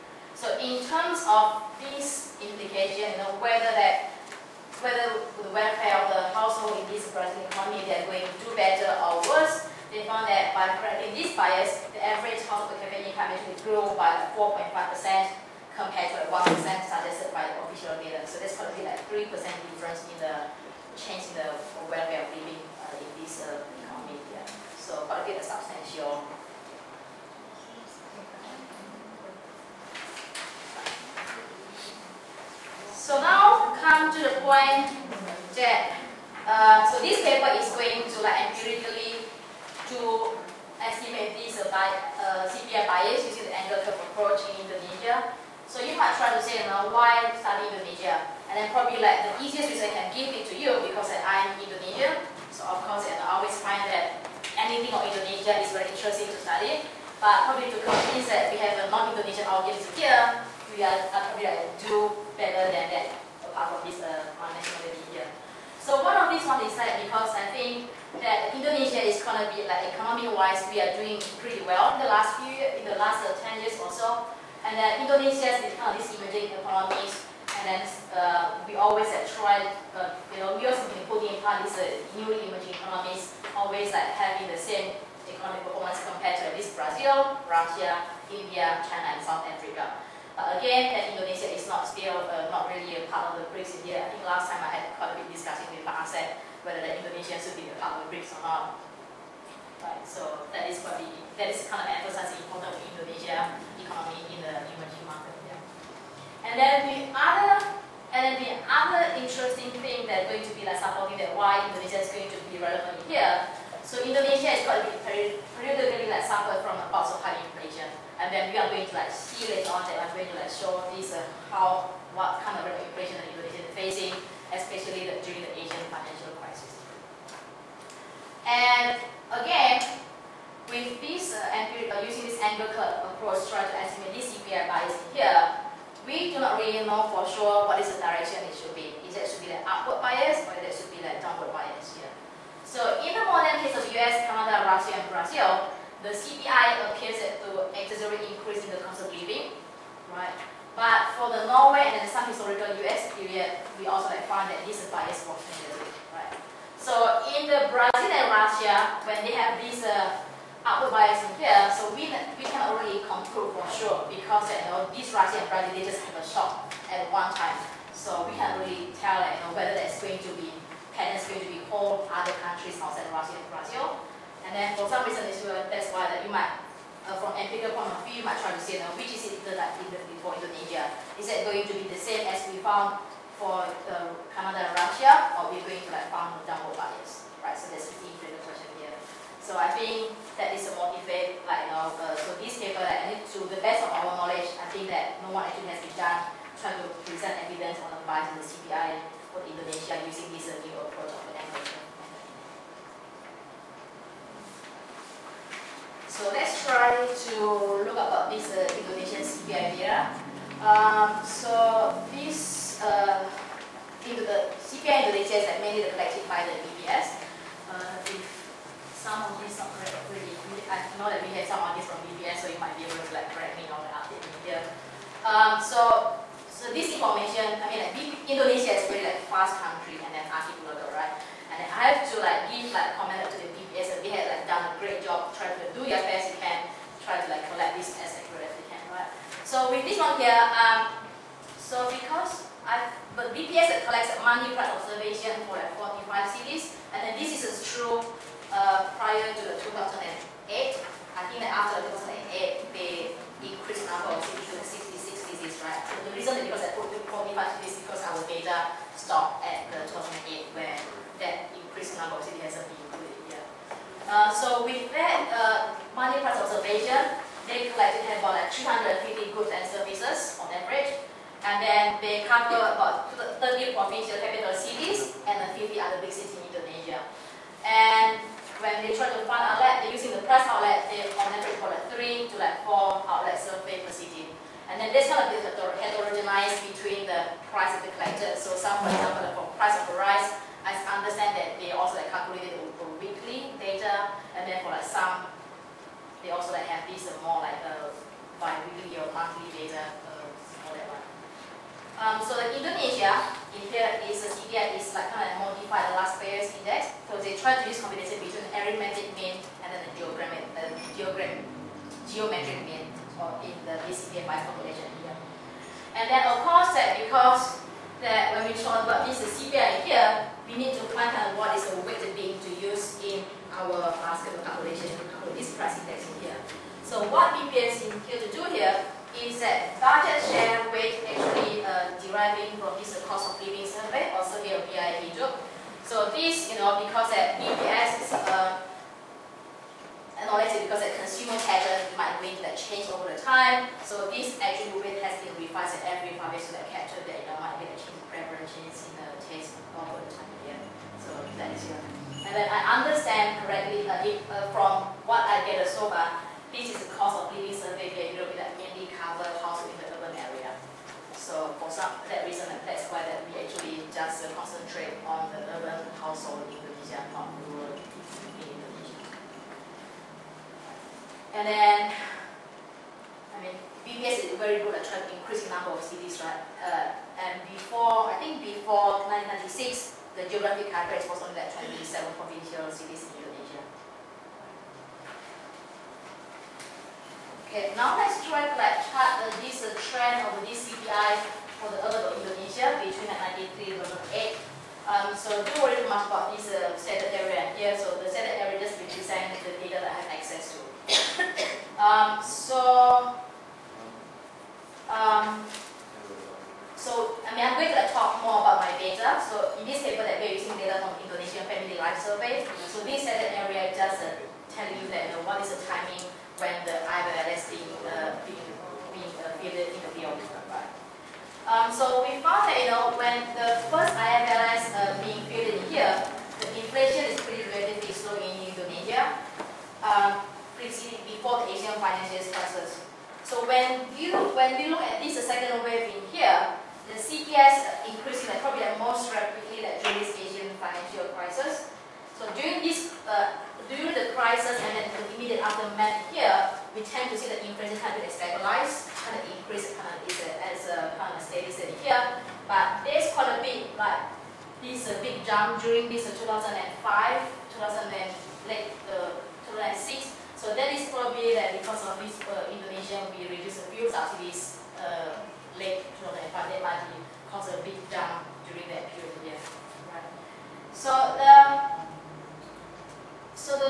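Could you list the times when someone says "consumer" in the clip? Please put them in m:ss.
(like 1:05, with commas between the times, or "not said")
5:41.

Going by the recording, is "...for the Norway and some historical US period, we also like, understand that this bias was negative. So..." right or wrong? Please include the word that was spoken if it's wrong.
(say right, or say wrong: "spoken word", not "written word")
wrong: "found", not "understand".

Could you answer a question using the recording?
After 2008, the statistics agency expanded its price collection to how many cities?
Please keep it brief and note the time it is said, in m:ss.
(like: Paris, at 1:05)
66, at 4:14.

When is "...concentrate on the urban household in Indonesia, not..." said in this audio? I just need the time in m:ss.
6:04.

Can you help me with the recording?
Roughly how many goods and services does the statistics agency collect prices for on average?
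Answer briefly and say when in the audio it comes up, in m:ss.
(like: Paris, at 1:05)
350, at 4:28.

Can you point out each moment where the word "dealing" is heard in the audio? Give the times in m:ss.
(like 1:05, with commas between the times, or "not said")
not said.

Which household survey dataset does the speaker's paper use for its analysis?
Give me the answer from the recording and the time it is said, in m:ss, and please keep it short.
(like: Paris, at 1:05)
Indonesian Family Life Survey, at 6:51.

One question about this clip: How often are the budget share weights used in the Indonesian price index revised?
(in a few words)
every 5 years.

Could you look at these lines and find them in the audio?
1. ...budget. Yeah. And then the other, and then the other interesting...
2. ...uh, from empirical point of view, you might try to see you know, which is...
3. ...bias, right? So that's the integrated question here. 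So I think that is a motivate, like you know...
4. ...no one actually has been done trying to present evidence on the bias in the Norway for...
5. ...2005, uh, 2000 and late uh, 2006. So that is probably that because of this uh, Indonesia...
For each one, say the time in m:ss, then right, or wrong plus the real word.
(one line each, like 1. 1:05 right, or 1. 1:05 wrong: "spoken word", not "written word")
1. 1:45 wrong: "market", not "budget"
2. 2:57 right
3. 3:06 right
4. 3:15 wrong: "CPI", not "Norway"
5. 7:36 right.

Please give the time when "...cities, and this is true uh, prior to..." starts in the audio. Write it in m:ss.
4:06.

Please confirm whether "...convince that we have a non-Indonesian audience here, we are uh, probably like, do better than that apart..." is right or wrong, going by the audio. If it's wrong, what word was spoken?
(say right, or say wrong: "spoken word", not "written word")
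right.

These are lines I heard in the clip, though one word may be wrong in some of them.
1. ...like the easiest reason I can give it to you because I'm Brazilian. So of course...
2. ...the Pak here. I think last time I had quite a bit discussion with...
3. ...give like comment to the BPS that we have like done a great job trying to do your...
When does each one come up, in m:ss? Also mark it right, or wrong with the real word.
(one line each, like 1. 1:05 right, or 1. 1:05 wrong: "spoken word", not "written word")
1. 0:49 wrong: "Indonesian", not "Brazilian"
2. 1:33 wrong: "BRICS", not "Pak"
3. 3:52 right.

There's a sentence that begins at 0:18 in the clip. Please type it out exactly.
So that's probably like 3% difference in the change in the welfare of living uh, in this uh, economy.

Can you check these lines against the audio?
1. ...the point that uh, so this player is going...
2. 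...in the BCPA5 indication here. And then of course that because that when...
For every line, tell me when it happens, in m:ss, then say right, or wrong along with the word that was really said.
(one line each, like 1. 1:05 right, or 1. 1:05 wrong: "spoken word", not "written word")
1. 0:34 wrong: "paper", not "player"
2. 5:13 wrong: "population", not "indication".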